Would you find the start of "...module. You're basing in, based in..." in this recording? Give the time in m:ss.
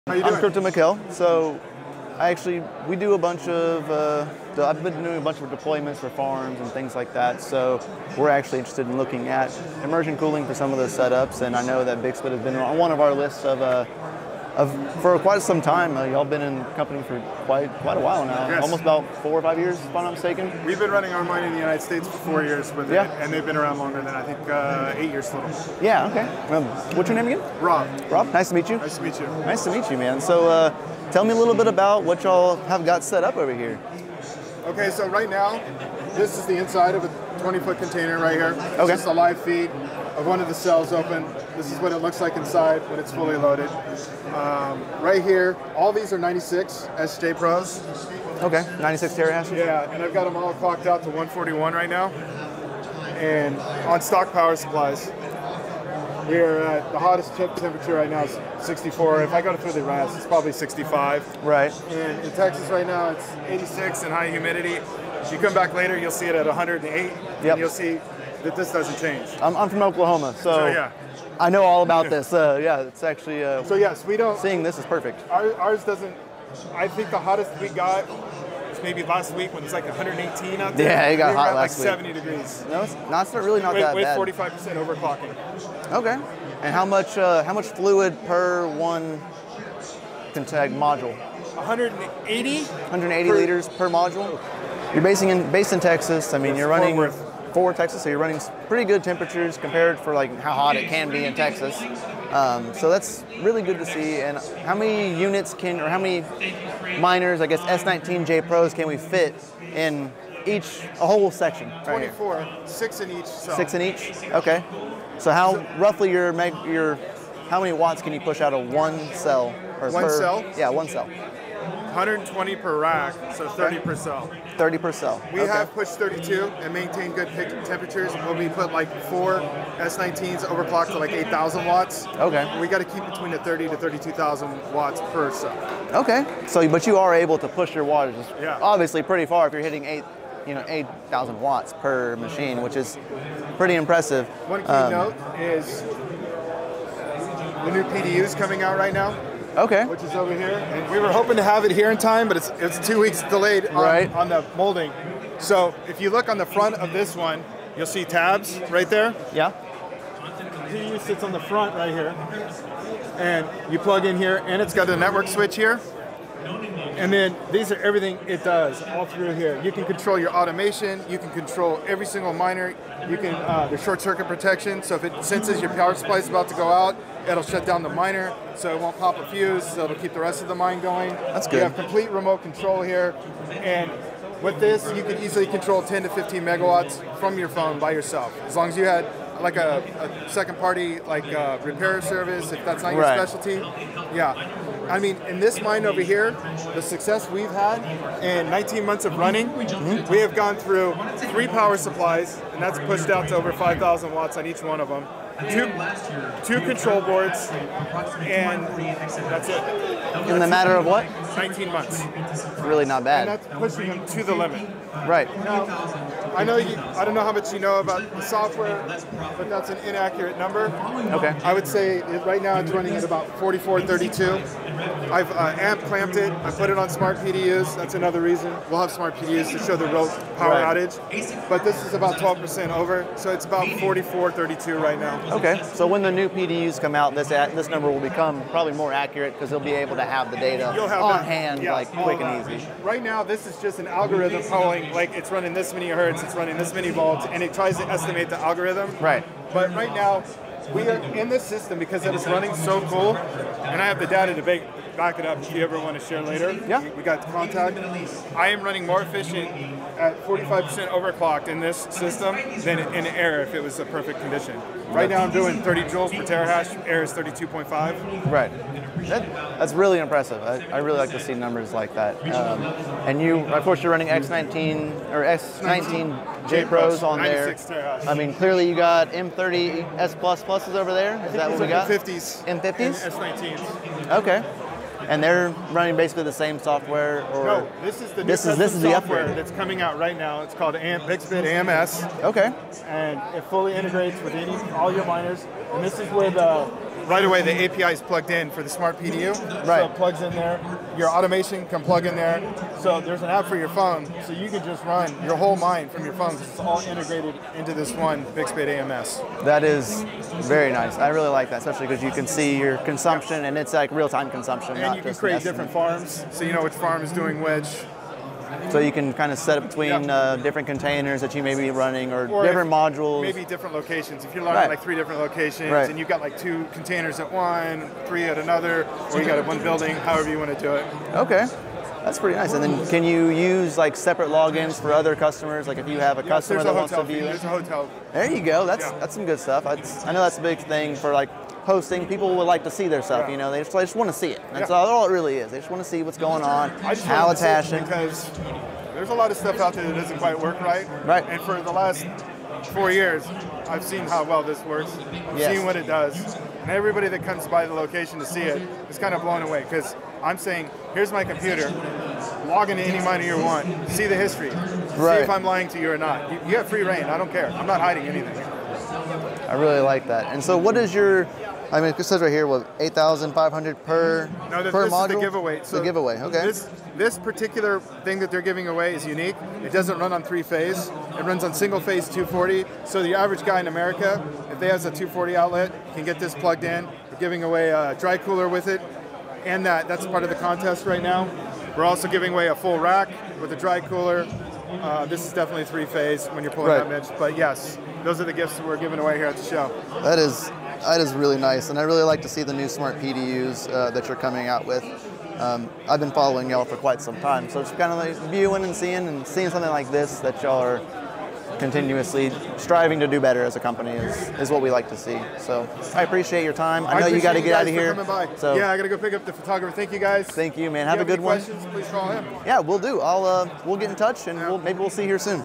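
1:33.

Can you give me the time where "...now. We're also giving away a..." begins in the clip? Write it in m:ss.
6:31.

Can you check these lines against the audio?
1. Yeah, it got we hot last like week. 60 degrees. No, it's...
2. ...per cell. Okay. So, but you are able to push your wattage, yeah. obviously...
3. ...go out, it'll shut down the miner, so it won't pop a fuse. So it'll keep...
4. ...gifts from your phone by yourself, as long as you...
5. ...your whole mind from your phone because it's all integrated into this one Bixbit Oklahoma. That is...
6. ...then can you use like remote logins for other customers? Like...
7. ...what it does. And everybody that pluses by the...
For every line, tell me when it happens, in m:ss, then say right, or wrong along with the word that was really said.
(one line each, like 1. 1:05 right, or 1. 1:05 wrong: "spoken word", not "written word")
1. 1:20 wrong: "70", not "60"
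2. 2:15 right
3. 2:56 right
4. 3:06 wrong: "megawatts", not "gifts"
5. 5:05 wrong: "AMS", not "Oklahoma"
6. 5:32 wrong: "separate", not "remote"
7. 5:55 wrong: "comes", not "pluses".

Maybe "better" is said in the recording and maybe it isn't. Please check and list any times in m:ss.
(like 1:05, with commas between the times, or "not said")
6:53.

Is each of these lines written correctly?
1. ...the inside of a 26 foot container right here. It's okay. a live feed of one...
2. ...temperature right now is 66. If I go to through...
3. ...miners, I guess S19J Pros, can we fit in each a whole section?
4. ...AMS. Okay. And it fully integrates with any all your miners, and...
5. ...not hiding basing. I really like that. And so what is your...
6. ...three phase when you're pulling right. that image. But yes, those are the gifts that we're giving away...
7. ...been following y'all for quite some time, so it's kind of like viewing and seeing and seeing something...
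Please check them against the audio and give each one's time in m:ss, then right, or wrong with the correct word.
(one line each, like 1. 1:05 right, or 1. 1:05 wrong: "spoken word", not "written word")
1. 0:36 wrong: "20", not "26"
2. 0:57 wrong: "64", not "66"
3. 1:46 right
4. 4:51 right
5. 6:07 wrong: "anything", not "basing"
6. 6:35 right
7. 6:45 right.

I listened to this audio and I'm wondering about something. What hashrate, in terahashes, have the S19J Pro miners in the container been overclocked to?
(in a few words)
141.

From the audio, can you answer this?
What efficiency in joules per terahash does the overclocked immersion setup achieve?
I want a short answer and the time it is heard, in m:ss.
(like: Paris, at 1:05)
30, at 4:25.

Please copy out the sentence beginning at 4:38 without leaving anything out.
I mean, clearly you got M30 S plus pluses over there.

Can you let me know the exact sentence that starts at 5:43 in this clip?
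You know, they just, they just want to see it.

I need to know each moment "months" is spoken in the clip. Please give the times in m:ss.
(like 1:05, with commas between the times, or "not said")
3:18, 3:31.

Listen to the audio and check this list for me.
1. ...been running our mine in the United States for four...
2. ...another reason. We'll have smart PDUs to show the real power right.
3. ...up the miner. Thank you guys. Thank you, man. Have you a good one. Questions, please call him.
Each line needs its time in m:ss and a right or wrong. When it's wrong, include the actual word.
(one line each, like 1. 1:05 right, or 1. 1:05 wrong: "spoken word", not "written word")
1. 0:20 right
2. 3:47 right
3. 6:59 wrong: "photographer", not "miner".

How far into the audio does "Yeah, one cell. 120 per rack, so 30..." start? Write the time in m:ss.
2:00.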